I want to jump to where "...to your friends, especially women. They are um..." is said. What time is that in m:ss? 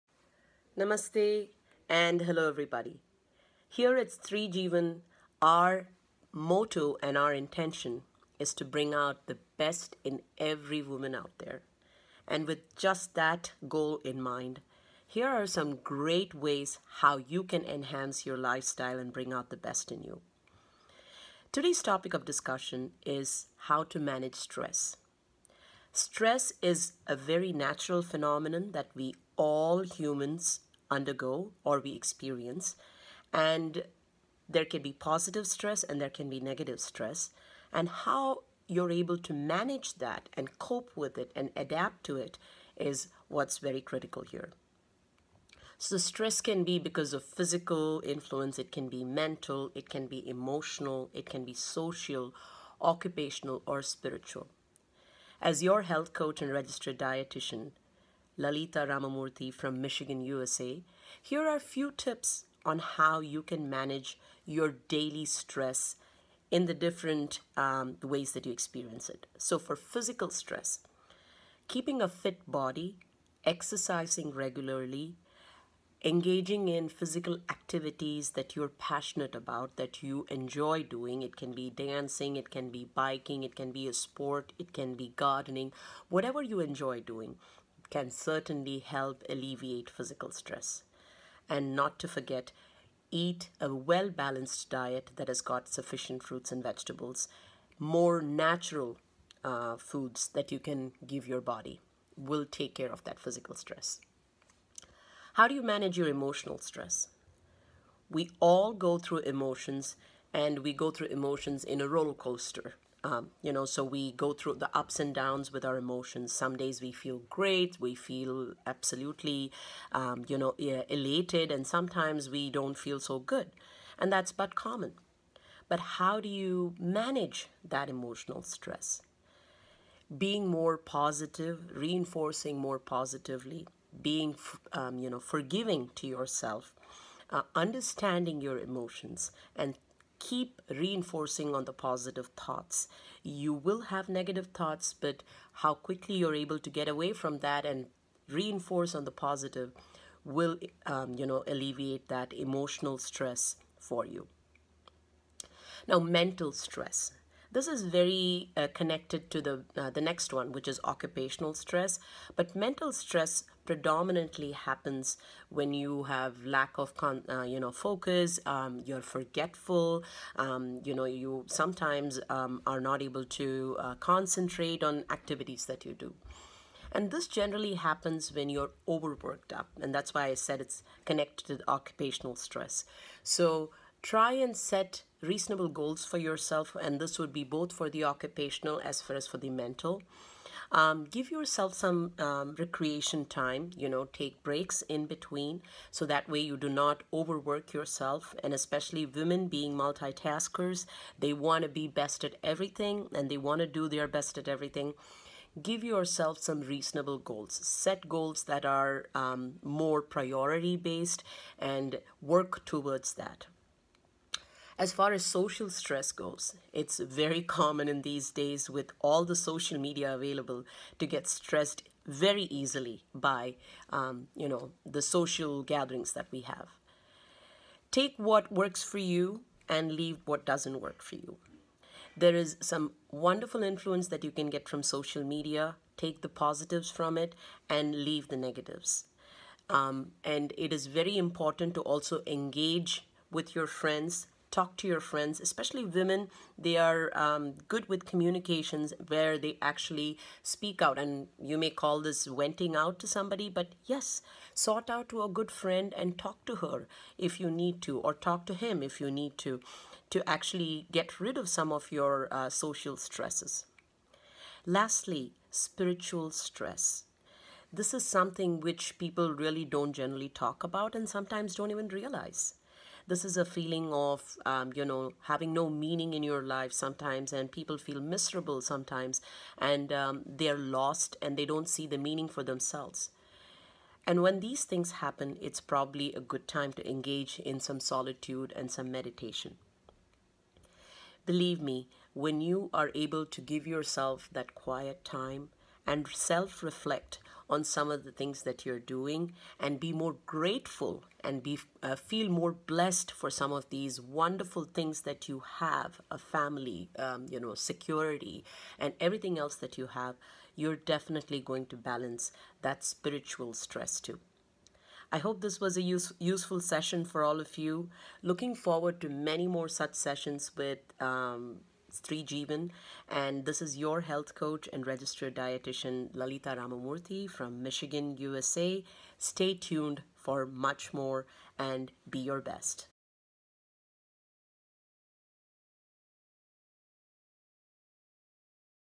4:04.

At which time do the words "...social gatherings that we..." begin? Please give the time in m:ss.
3:45.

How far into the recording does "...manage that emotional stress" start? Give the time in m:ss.
2:06.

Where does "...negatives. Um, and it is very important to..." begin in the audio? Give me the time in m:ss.
3:58.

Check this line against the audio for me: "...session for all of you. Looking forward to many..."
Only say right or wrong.
right.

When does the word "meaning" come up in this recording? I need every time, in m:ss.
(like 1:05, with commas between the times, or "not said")
4:35, 4:41.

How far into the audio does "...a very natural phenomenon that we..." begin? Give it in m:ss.
0:27.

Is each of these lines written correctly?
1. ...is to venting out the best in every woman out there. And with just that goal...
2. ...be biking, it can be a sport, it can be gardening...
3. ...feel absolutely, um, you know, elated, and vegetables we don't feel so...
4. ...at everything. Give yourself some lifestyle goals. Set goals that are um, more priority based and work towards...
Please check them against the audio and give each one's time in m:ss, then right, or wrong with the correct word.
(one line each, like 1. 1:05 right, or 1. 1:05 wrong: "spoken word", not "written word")
1. 0:08 wrong: "bring", not "venting"
2. 1:22 right
3. 1:57 wrong: "sometimes", not "vegetables"
4. 3:24 wrong: "reasonable", not "lifestyle".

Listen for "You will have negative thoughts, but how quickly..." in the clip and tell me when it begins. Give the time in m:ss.
2:23.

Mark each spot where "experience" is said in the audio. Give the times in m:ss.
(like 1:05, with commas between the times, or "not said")
0:31, 1:08.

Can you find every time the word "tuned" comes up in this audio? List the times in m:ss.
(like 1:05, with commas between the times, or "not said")
5:29.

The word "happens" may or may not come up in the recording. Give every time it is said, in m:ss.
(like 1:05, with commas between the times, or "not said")
2:44, 2:57, 4:45.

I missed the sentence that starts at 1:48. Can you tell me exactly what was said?
We all go through emotions and we go through emotions in a roller coaster.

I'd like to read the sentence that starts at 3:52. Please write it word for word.
There is some wonderful influence that you can get from social media.